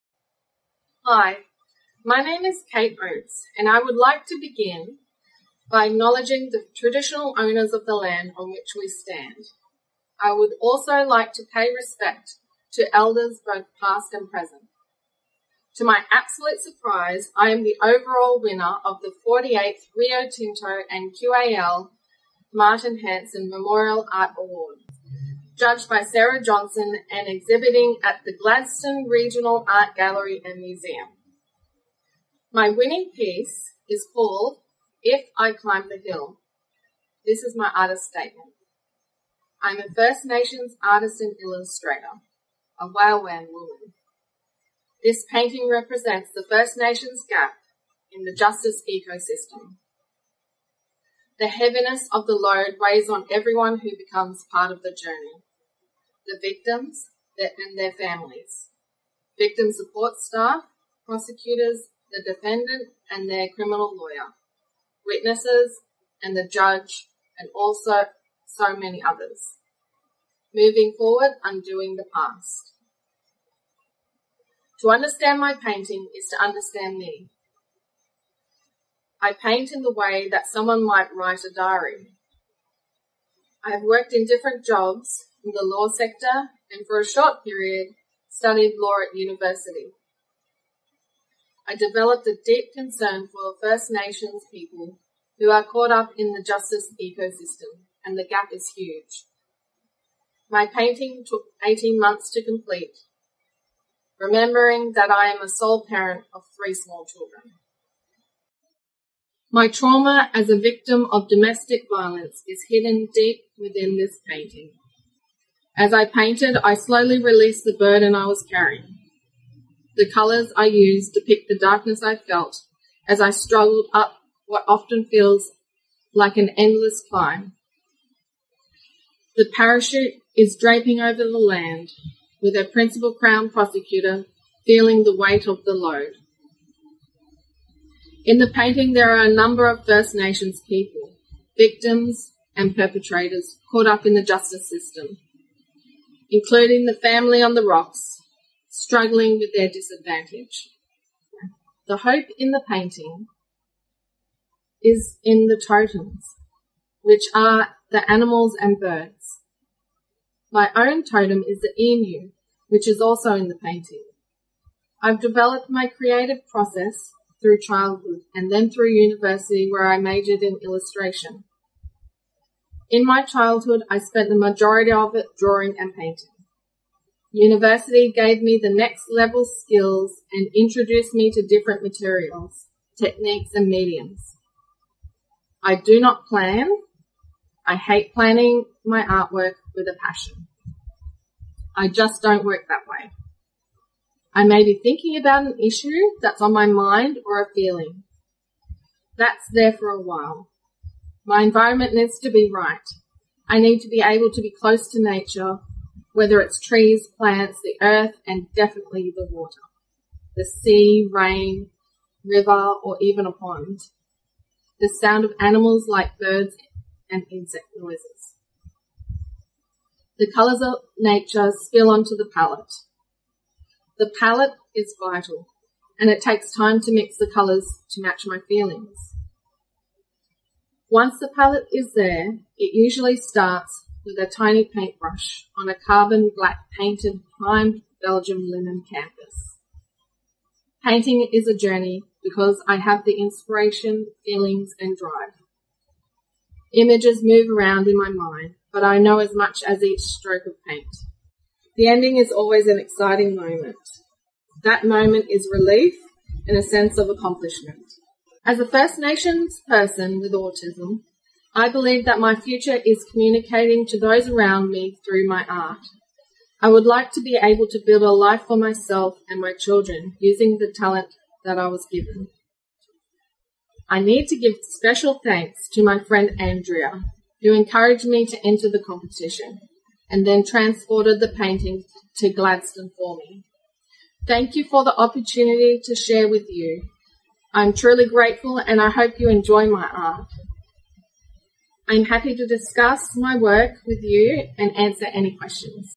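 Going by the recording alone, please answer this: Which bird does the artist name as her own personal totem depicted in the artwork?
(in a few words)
Emu.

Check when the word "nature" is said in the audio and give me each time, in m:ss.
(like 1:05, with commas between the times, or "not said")
3:25, 3:40.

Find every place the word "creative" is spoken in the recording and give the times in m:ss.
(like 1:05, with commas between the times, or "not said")
2:45.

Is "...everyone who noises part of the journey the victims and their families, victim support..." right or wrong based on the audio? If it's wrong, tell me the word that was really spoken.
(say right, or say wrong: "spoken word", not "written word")
wrong: "becomes", not "noises".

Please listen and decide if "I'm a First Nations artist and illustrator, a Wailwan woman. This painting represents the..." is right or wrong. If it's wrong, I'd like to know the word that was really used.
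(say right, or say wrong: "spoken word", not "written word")
right.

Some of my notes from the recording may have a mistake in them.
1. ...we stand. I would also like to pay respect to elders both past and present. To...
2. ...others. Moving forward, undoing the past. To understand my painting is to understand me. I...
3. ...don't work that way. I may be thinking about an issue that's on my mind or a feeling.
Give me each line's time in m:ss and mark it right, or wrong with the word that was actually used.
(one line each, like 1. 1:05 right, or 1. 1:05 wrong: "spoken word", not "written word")
1. 0:08 right
2. 1:09 right
3. 3:12 right.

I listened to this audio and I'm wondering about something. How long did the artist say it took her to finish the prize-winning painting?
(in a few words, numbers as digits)
18 months.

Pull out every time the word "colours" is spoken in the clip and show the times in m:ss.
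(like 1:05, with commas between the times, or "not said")
2:00, 3:40, 3:47.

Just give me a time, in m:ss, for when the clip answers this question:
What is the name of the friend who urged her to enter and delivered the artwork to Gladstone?
4:36.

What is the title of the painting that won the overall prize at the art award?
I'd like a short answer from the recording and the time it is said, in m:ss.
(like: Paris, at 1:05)
If I Climb the Hill, at 0:35.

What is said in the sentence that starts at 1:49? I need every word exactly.
My trauma as a victim of domestic violence is hidden deep within this painting.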